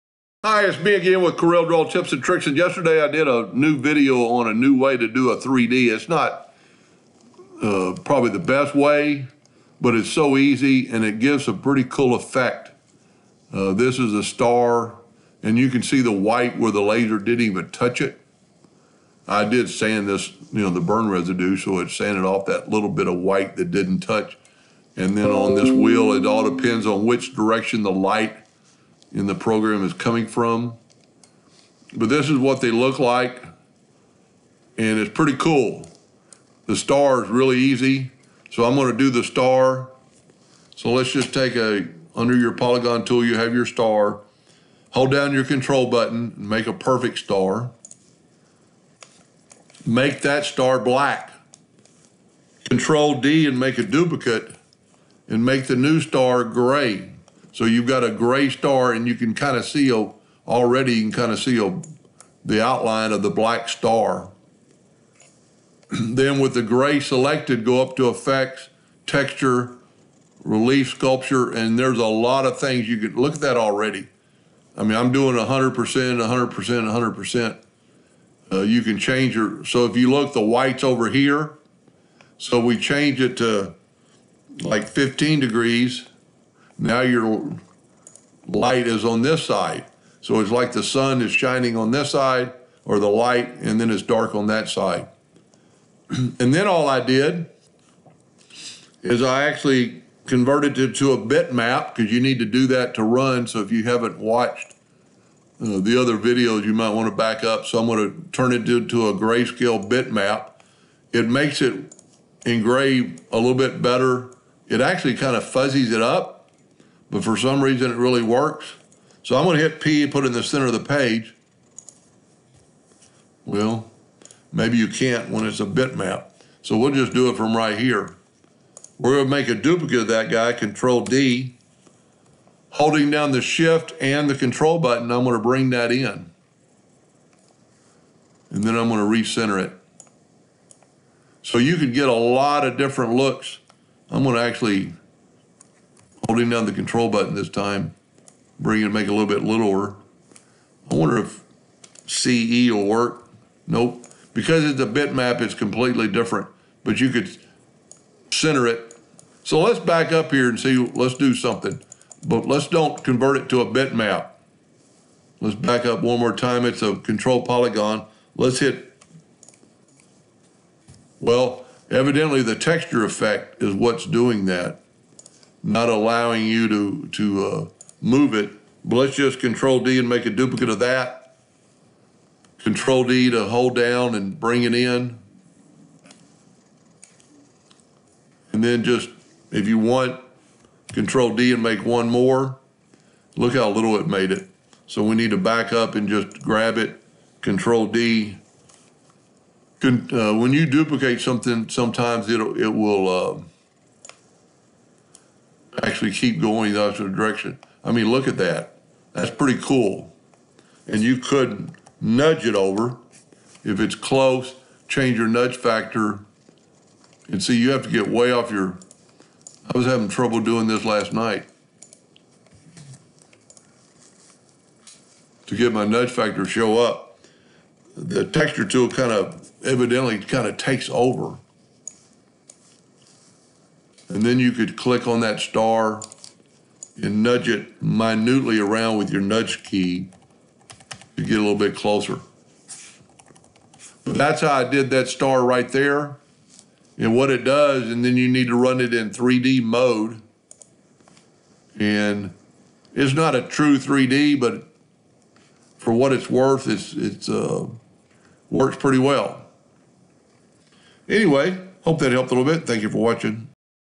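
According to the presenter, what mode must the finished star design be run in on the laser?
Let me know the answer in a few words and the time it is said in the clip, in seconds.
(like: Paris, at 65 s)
3D mode, at 249 s.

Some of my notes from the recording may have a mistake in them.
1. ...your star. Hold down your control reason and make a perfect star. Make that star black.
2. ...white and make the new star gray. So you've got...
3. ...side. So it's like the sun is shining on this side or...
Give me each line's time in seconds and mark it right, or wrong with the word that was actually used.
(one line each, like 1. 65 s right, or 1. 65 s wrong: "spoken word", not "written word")
1. 43 s wrong: "button", not "reason"
2. 53 s wrong: "duplicate", not "white"
3. 89 s right.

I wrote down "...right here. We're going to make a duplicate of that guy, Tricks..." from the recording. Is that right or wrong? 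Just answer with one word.
wrong.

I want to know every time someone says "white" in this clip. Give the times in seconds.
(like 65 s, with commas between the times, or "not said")
16 s, 23 s, 80 s.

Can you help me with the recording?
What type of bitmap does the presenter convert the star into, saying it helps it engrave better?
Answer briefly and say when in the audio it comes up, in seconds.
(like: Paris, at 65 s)
grayscale, at 109 s.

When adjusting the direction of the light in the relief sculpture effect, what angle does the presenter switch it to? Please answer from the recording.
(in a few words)
15 degrees.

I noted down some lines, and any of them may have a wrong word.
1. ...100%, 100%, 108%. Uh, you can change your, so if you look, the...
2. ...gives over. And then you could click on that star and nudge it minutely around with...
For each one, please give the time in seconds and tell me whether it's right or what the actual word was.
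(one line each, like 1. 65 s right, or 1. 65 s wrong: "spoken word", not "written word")
1. 75 s wrong: "100", not "108"
2. 230 s wrong: "takes", not "gives".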